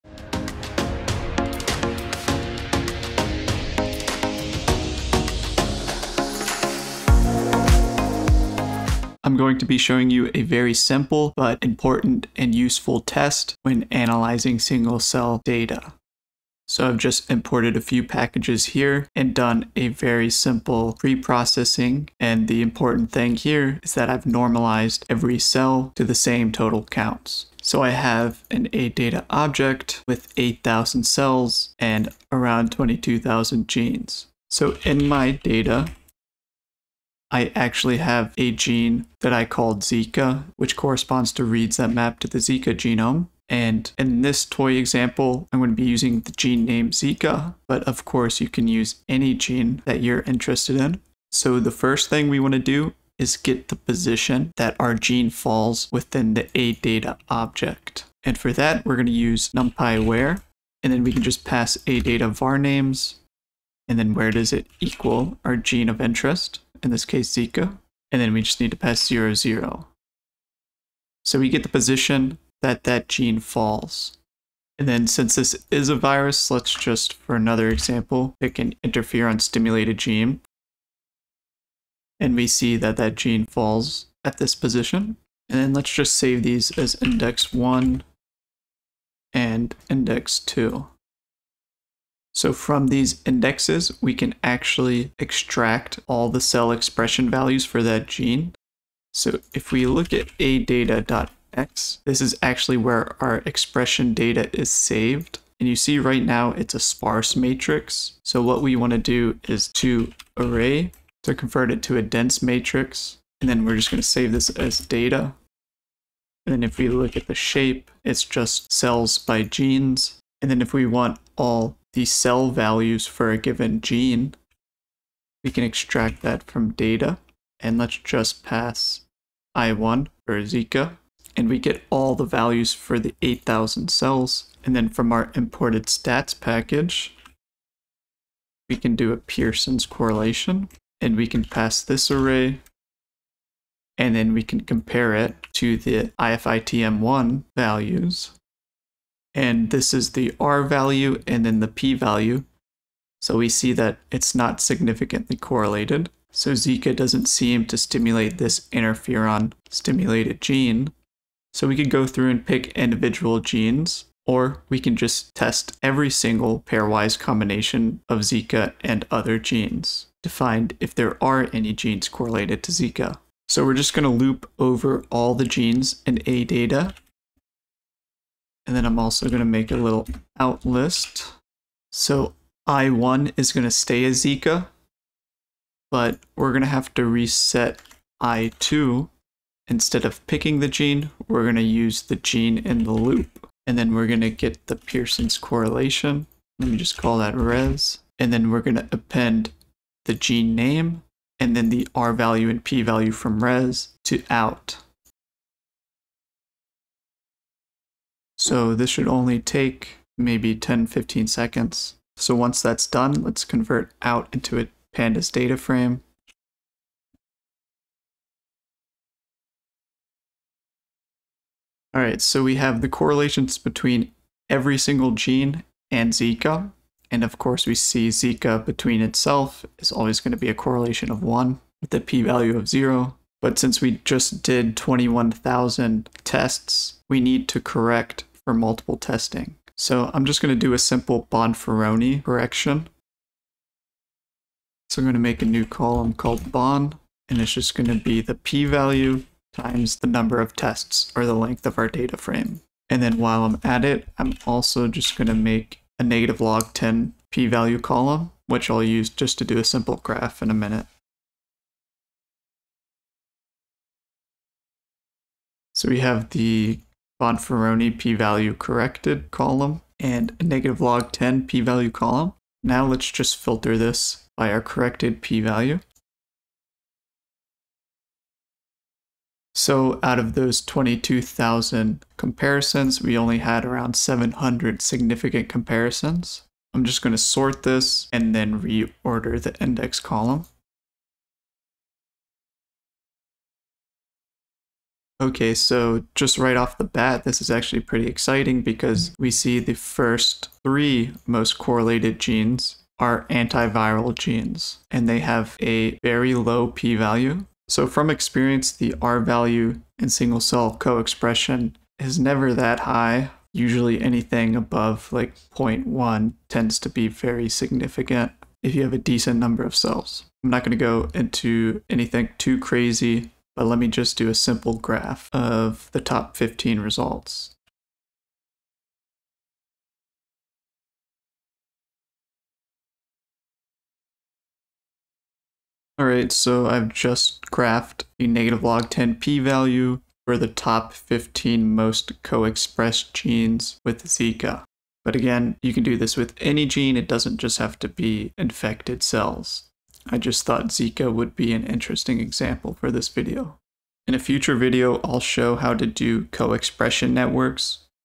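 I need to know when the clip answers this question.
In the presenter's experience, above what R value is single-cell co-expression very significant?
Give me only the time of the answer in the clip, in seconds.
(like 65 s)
315 s.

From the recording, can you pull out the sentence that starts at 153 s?
So we see that it's not significantly correlated.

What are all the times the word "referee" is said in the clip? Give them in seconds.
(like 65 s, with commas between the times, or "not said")
not said.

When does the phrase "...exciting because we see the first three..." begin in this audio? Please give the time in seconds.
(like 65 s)
298 s.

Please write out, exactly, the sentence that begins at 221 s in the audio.
All right, so we have the correlations between every single gene and Zika.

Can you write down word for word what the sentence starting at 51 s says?
So the first thing we want to do is get the position that our gene falls within the A data object.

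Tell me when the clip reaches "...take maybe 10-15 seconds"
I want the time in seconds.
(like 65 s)
209 s.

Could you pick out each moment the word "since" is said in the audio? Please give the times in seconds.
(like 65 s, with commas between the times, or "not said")
75 s, 233 s.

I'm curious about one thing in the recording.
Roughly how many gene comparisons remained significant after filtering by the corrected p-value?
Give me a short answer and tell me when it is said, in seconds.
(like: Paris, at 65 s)
around 700, at 283 s.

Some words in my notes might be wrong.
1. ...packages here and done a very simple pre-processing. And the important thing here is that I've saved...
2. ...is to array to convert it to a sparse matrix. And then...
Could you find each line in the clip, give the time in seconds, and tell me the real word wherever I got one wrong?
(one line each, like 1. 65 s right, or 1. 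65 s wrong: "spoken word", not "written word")
1. 18 s wrong: "normalized", not "saved"
2. 109 s wrong: "dense", not "sparse".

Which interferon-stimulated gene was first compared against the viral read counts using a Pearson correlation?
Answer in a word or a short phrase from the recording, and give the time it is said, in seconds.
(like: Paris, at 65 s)
IFITM1, at 146 s.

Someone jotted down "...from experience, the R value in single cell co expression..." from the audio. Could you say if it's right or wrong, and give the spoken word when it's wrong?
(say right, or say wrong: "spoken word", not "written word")
right.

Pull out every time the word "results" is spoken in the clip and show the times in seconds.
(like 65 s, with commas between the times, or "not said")
326 s.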